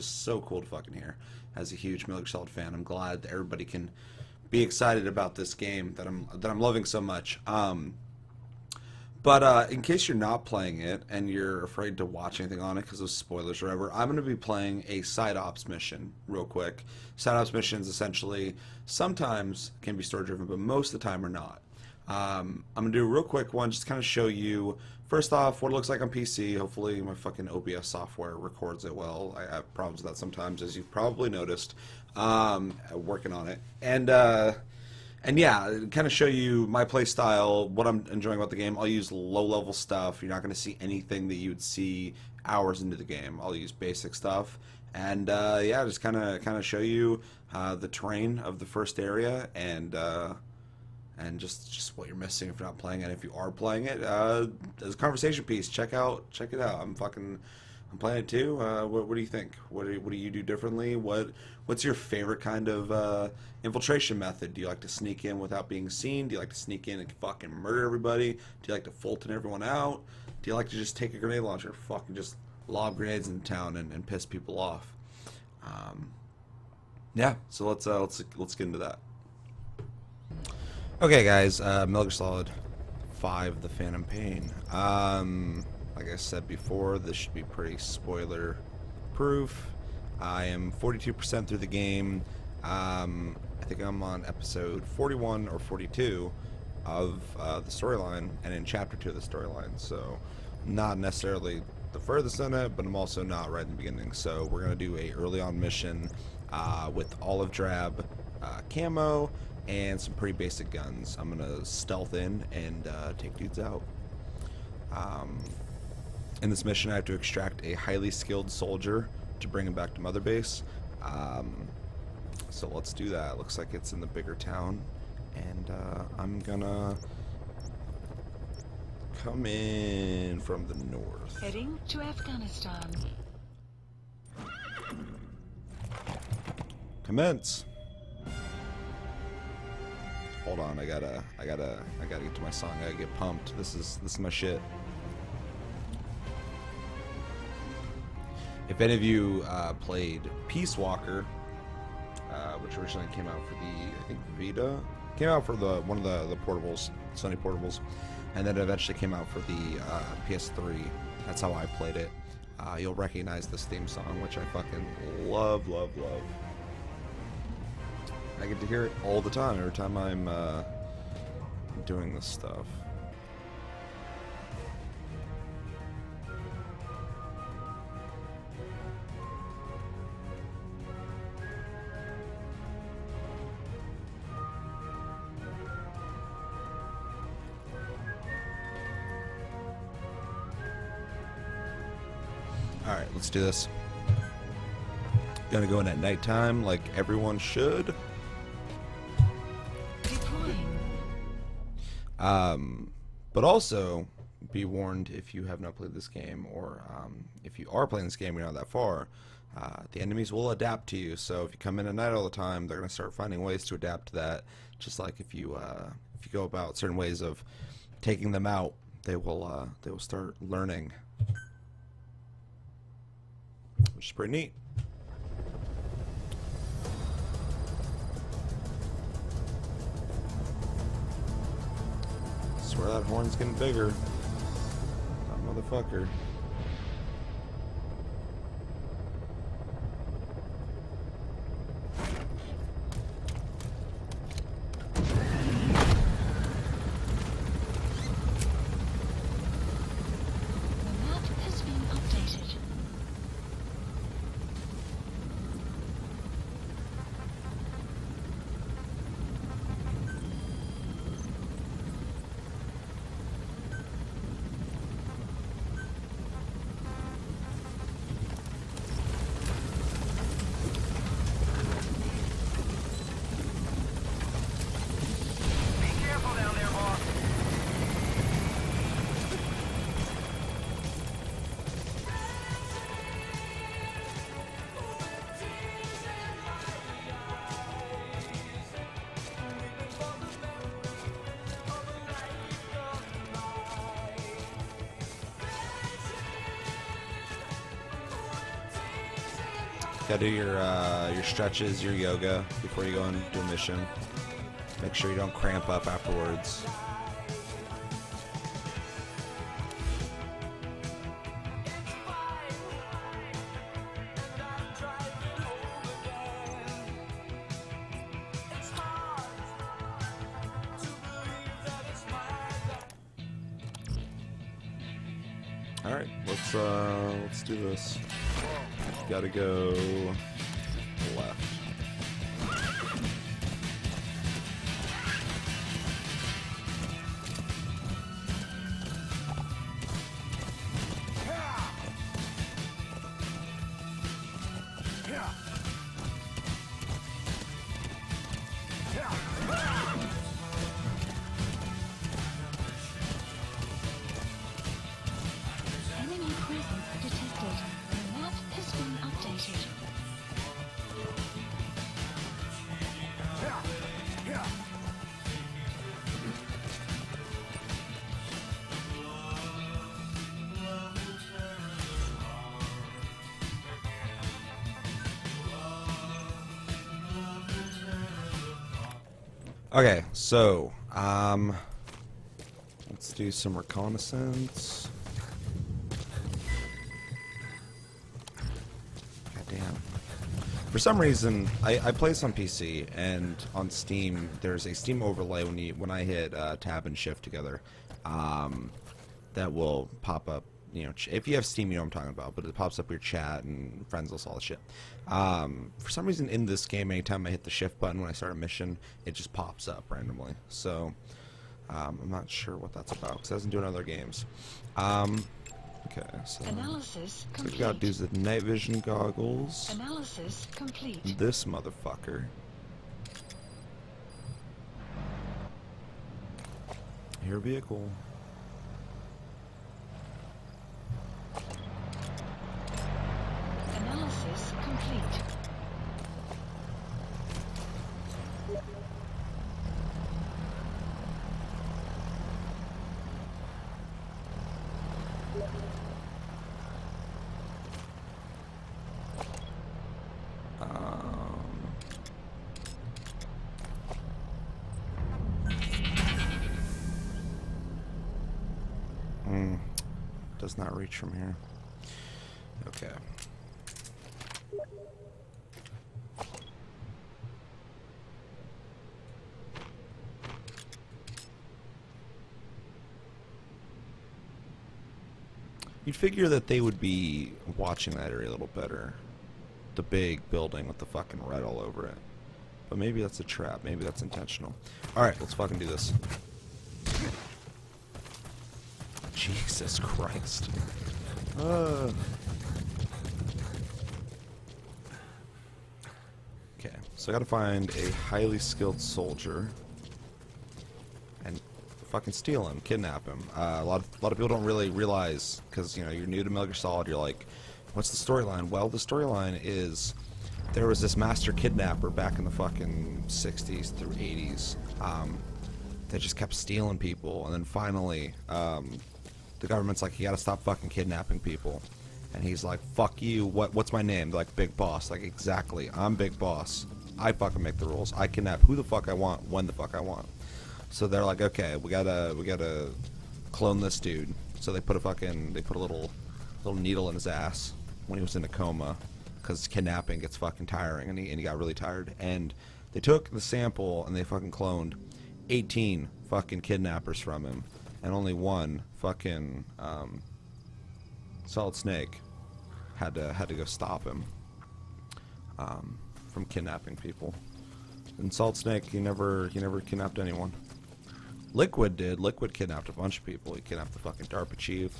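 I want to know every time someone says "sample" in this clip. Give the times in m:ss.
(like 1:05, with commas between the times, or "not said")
9:03.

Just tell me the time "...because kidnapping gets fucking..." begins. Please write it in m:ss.
8:59.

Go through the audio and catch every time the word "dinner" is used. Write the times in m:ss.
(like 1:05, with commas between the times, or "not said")
not said.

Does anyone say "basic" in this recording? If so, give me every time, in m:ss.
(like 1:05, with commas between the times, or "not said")
0:43, 1:50.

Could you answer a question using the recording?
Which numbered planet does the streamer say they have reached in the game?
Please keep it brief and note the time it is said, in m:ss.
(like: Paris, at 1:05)
Planet Two, at 0:57.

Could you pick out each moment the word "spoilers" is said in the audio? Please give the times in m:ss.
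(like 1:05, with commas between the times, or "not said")
0:13, 1:27.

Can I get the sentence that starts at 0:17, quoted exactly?
Side ops missions essentially sometimes can be story driven, but most of the time are not.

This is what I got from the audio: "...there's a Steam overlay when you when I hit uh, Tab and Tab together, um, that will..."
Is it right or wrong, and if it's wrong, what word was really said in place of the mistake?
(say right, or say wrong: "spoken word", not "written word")
wrong: "Shift", not "Tab".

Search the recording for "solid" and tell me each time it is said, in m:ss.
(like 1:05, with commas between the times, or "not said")
0:02, 1:22, 8:26, 9:11, 9:18.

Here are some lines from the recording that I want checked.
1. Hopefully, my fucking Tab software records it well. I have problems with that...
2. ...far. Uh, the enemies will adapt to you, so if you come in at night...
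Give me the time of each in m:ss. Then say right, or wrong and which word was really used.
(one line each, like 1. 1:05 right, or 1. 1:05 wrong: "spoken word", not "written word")
1. 0:26 wrong: "OBS", not "Tab"
2. 3:28 right.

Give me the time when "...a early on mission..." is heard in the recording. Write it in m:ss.
1:44.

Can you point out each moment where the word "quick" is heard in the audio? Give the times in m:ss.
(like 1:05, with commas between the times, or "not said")
0:16, 0:23.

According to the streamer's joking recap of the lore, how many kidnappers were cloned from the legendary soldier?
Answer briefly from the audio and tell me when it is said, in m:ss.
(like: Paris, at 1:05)
18, at 9:05.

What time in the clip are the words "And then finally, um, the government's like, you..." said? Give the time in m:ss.
8:37.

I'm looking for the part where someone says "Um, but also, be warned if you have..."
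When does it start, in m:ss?
3:22.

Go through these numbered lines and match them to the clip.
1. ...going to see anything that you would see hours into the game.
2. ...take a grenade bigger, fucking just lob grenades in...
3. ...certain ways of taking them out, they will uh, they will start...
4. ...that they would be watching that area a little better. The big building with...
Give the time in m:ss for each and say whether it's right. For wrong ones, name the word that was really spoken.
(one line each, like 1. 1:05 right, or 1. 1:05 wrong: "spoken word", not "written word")
1. 0:40 right
2. 1:10 wrong: "launcher", not "bigger"
3. 3:36 right
4. 7:56 right.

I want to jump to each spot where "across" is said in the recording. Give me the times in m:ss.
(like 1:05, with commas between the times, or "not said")
not said.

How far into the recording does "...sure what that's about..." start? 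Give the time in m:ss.
6:52.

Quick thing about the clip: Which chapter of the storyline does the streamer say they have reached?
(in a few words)
chapter 2.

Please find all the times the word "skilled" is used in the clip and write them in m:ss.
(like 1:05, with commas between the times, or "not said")
1:58, 8:18.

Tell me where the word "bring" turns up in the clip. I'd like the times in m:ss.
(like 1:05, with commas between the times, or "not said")
1:59.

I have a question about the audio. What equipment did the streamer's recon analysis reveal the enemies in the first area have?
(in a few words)
night vision goggles.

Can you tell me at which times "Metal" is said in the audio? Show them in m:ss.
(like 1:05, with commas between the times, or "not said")
0:02, 8:26.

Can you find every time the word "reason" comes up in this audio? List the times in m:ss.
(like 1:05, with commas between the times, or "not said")
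6:31, 6:46.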